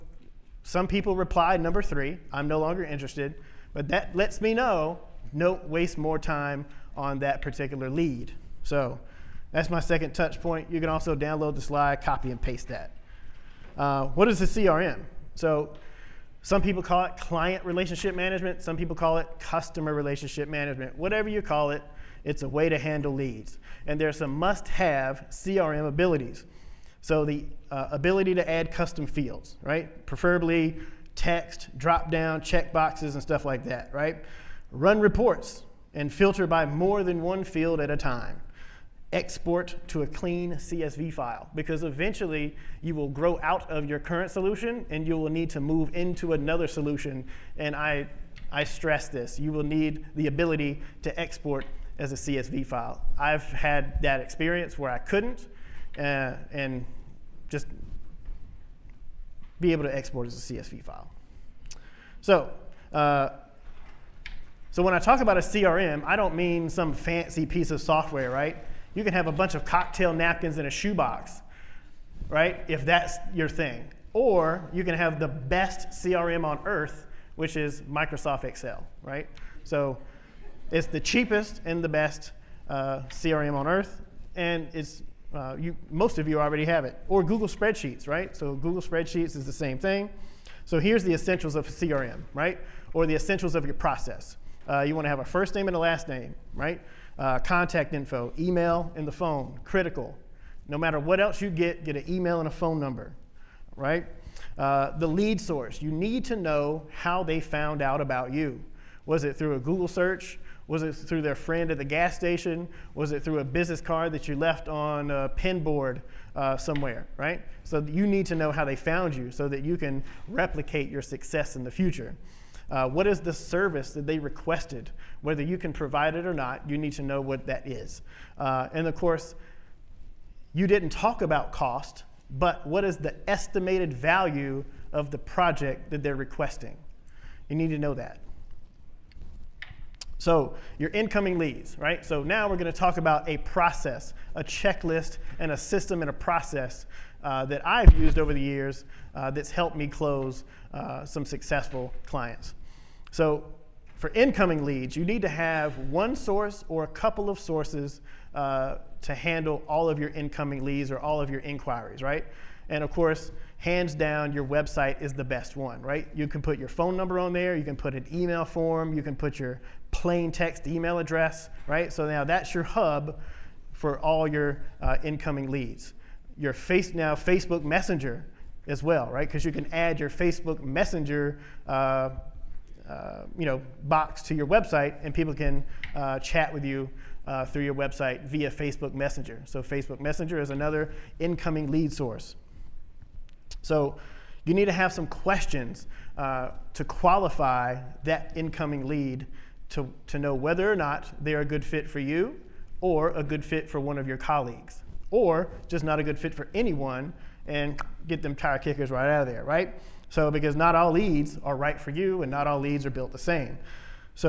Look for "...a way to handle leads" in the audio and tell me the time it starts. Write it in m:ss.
0:22.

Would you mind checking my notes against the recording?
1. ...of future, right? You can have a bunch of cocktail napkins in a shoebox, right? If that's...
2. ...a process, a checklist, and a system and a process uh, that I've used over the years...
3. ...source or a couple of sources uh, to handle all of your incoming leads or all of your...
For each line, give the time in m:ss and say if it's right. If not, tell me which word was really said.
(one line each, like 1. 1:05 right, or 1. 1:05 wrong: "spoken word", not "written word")
1. 1:07 wrong: "software", not "future"
2. 2:23 right
3. 2:36 right.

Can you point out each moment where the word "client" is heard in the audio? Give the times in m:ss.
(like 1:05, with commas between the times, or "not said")
0:17, 2:32.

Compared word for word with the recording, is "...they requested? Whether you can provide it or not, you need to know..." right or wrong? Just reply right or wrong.
right.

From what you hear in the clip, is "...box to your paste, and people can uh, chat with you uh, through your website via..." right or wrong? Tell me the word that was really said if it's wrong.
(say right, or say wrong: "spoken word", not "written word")
wrong: "website", not "paste".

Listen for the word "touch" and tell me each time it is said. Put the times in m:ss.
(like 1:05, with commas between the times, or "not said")
0:10.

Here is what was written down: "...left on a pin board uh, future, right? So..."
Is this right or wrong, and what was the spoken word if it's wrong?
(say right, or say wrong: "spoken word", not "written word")
wrong: "somewhere", not "future".